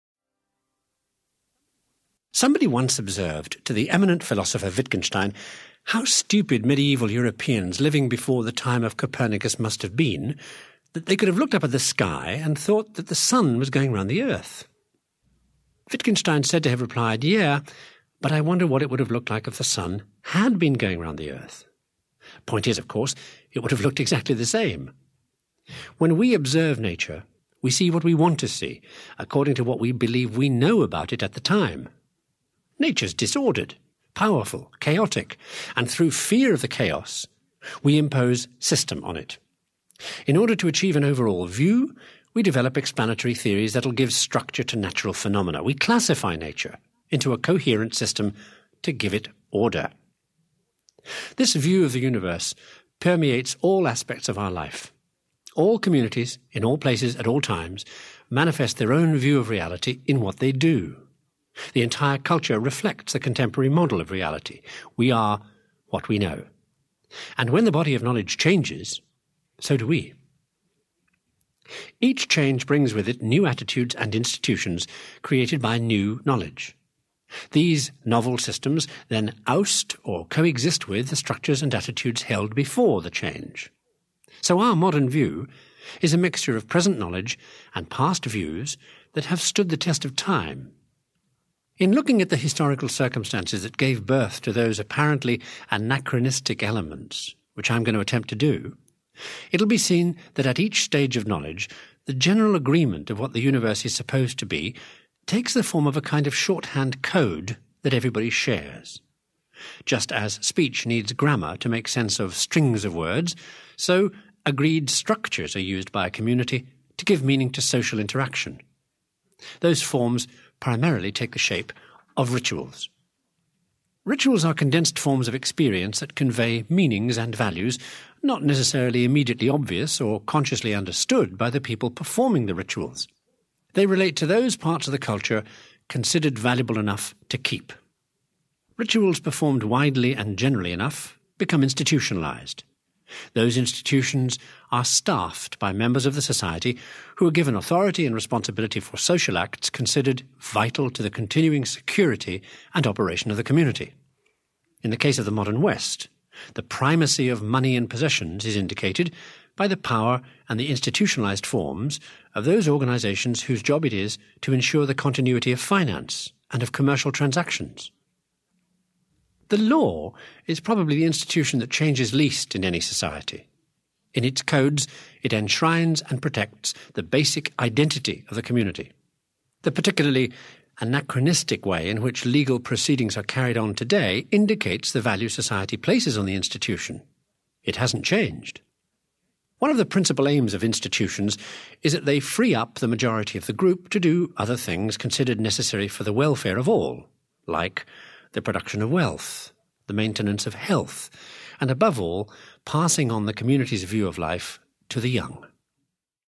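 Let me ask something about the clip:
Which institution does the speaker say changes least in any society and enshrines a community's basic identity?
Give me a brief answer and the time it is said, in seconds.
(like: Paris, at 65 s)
The law, at 169 s.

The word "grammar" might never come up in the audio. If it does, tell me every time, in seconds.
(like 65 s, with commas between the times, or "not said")
111 s.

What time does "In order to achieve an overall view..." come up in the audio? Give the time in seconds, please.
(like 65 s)
40 s.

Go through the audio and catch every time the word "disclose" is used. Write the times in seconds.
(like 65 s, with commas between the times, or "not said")
not said.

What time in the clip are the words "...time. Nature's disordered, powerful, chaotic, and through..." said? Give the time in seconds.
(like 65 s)
31 s.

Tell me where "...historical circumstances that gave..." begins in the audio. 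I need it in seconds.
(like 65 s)
92 s.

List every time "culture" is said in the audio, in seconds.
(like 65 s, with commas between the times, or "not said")
62 s, 134 s.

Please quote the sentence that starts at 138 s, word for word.
Rituals performed widely and generally enough become institutionalized.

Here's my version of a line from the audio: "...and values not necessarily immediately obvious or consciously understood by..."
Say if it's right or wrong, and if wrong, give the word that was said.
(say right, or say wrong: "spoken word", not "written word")
right.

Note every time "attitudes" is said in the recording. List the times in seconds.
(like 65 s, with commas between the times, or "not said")
73 s, 81 s.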